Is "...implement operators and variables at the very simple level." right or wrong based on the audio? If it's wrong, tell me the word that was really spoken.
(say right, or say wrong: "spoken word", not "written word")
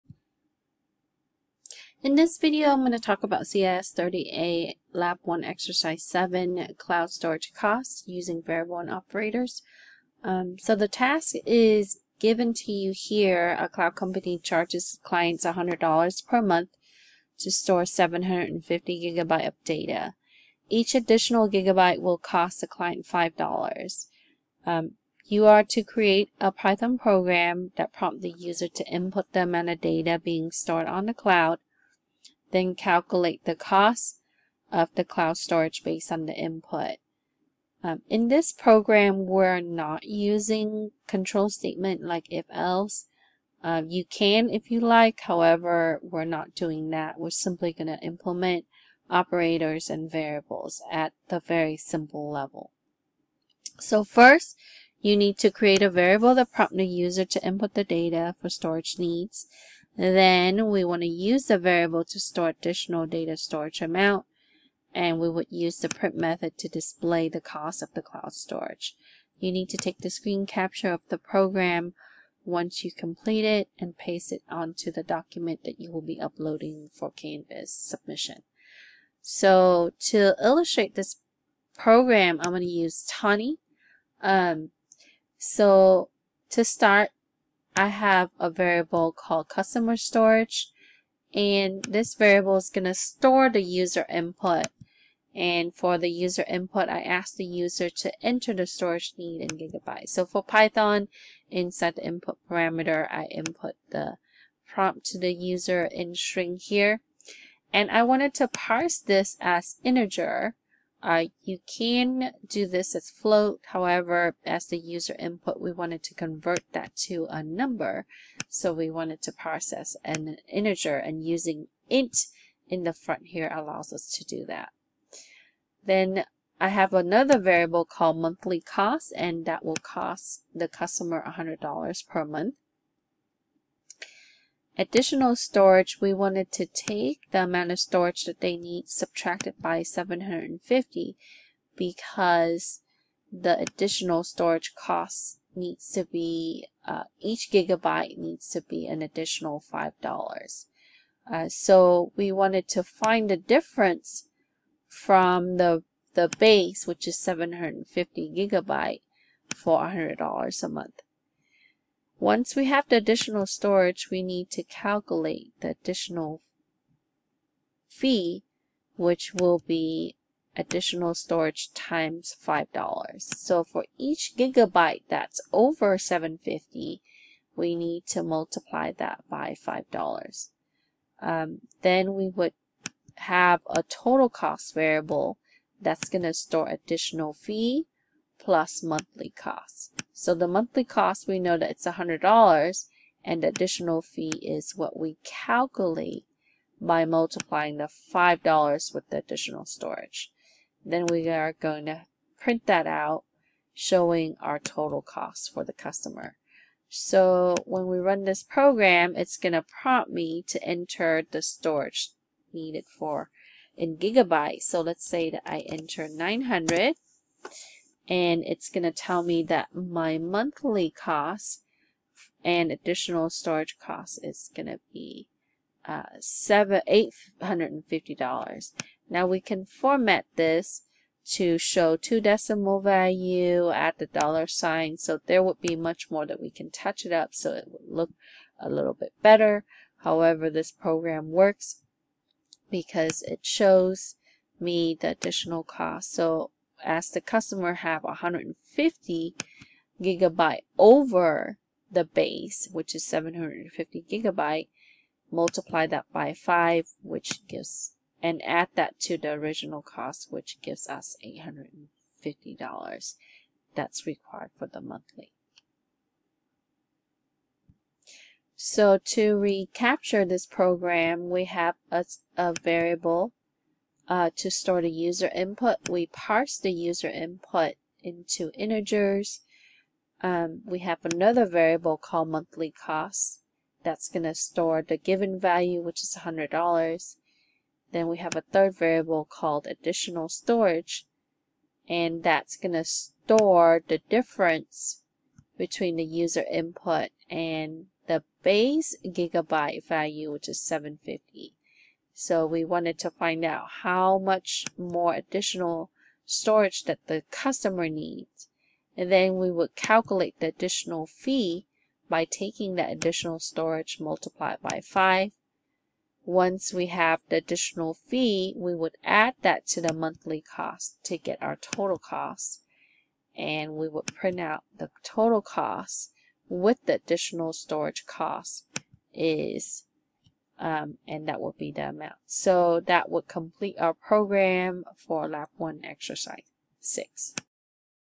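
right.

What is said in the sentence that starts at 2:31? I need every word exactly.
Uh, so we wanted to find the difference from the, the base, which is 750 gigabyte for $100 a month.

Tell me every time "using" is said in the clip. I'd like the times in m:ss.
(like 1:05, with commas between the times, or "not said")
0:08, 0:40, 2:01.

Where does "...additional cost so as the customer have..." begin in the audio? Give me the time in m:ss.
4:05.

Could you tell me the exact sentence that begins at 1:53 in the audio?
However, as the user input, we wanted to convert that to a number.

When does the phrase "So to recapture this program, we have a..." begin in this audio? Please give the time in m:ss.
4:28.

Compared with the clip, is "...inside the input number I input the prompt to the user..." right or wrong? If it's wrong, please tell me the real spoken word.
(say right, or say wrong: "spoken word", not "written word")
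wrong: "parameter", not "number".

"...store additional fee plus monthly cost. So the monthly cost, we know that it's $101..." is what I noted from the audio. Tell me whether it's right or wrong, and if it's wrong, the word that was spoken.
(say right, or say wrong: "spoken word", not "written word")
wrong: "100", not "101".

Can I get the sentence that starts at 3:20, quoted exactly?
Then we are going to print that out, showing our total cost for the customer.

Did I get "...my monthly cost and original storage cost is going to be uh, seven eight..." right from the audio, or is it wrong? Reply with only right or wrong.
wrong.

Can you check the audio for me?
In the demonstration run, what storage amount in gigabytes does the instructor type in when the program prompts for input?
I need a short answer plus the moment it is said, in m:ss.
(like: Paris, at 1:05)
900, at 3:36.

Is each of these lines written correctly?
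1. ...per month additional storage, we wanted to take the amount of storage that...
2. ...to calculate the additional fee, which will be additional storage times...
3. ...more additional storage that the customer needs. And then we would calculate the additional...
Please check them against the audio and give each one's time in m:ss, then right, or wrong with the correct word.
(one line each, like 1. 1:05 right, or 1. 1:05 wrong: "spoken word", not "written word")
1. 2:12 right
2. 2:44 right
3. 5:04 right.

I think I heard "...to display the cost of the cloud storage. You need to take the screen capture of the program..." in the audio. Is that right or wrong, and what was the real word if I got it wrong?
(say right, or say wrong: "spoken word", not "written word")
right.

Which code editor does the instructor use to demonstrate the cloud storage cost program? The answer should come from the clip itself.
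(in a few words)
Thonny.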